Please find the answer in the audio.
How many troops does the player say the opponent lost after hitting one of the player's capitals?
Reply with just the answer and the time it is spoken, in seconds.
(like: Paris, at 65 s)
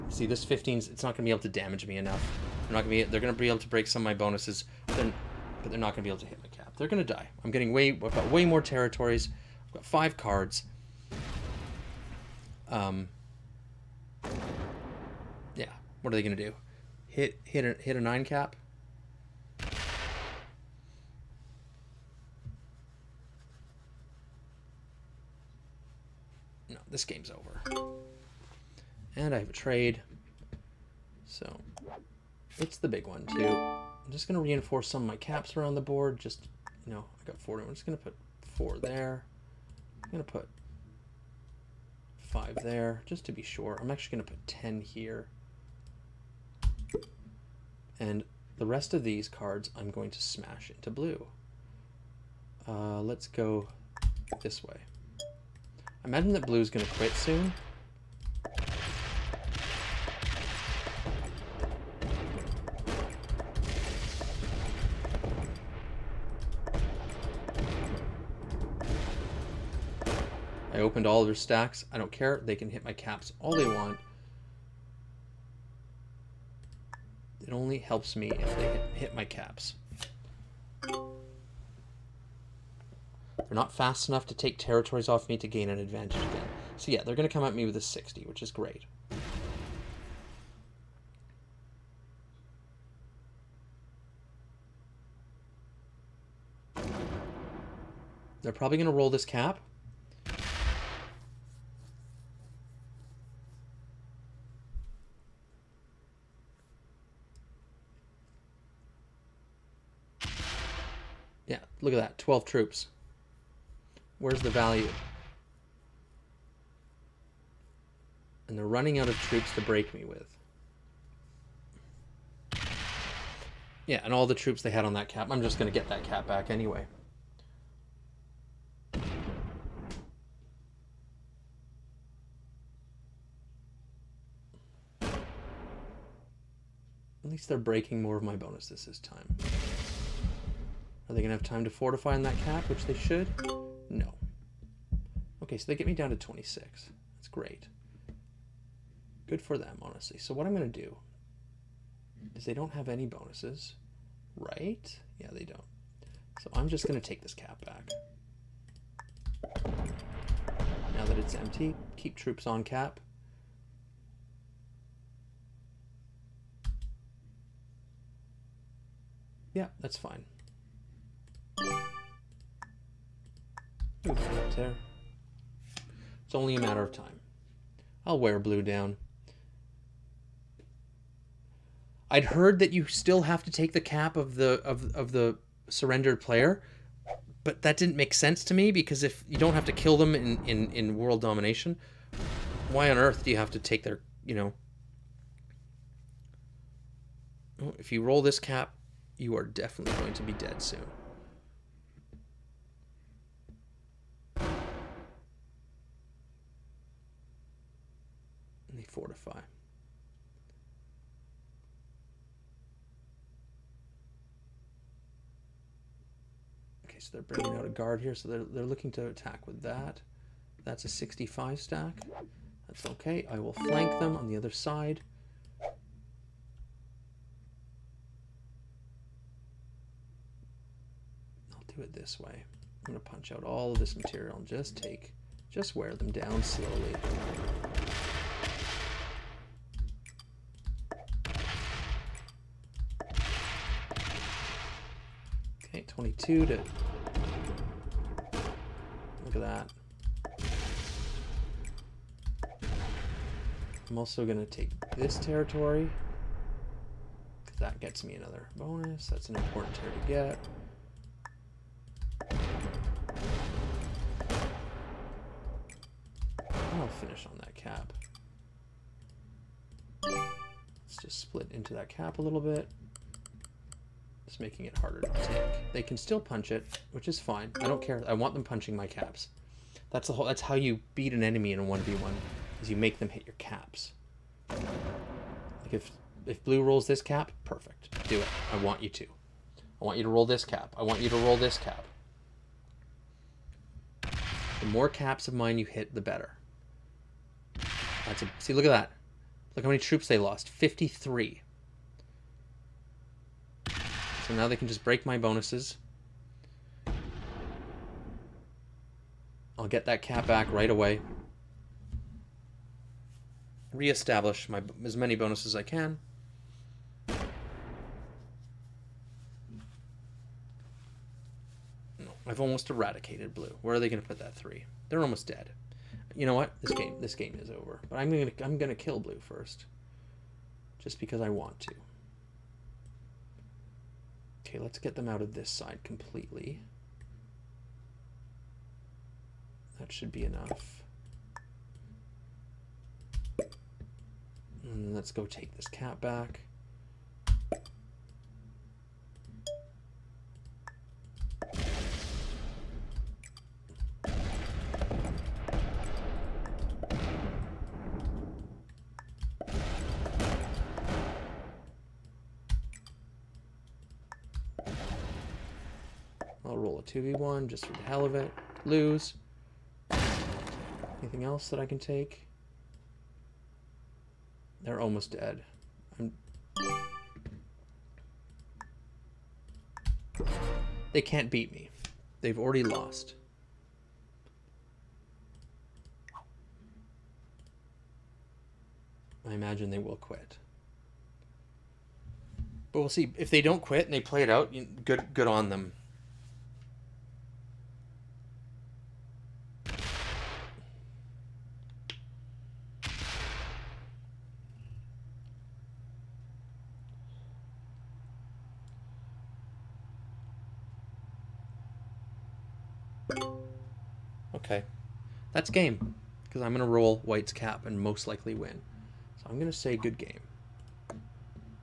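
53, at 300 s.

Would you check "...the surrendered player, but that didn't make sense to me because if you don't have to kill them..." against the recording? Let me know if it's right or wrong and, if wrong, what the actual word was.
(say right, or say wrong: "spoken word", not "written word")
right.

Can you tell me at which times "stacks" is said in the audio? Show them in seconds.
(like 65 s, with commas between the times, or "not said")
71 s, 221 s.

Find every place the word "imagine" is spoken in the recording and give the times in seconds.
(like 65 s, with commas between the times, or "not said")
56 s, 389 s.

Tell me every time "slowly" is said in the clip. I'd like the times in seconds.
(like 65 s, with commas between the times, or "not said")
236 s.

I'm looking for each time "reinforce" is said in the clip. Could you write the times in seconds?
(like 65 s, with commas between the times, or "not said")
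34 s.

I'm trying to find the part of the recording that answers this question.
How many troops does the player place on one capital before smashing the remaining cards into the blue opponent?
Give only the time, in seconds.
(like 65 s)
44 s.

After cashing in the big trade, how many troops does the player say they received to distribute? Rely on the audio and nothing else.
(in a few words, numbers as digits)
40.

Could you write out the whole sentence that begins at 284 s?
Like if if blue rolls this cap, perfect.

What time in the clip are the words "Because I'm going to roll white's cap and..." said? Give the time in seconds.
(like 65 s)
416 s.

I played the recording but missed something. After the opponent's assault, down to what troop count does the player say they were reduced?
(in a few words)
26.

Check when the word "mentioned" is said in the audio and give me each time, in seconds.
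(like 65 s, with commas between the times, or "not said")
not said.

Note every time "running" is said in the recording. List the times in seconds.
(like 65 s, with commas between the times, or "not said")
118 s.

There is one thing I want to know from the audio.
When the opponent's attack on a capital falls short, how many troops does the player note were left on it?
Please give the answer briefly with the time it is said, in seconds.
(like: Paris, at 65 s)
12, at 112 s.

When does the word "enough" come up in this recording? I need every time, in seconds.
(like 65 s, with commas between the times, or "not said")
1 s, 84 s, 340 s.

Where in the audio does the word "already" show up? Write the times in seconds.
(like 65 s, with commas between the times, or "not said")
382 s.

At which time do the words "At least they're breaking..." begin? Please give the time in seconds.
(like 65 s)
135 s.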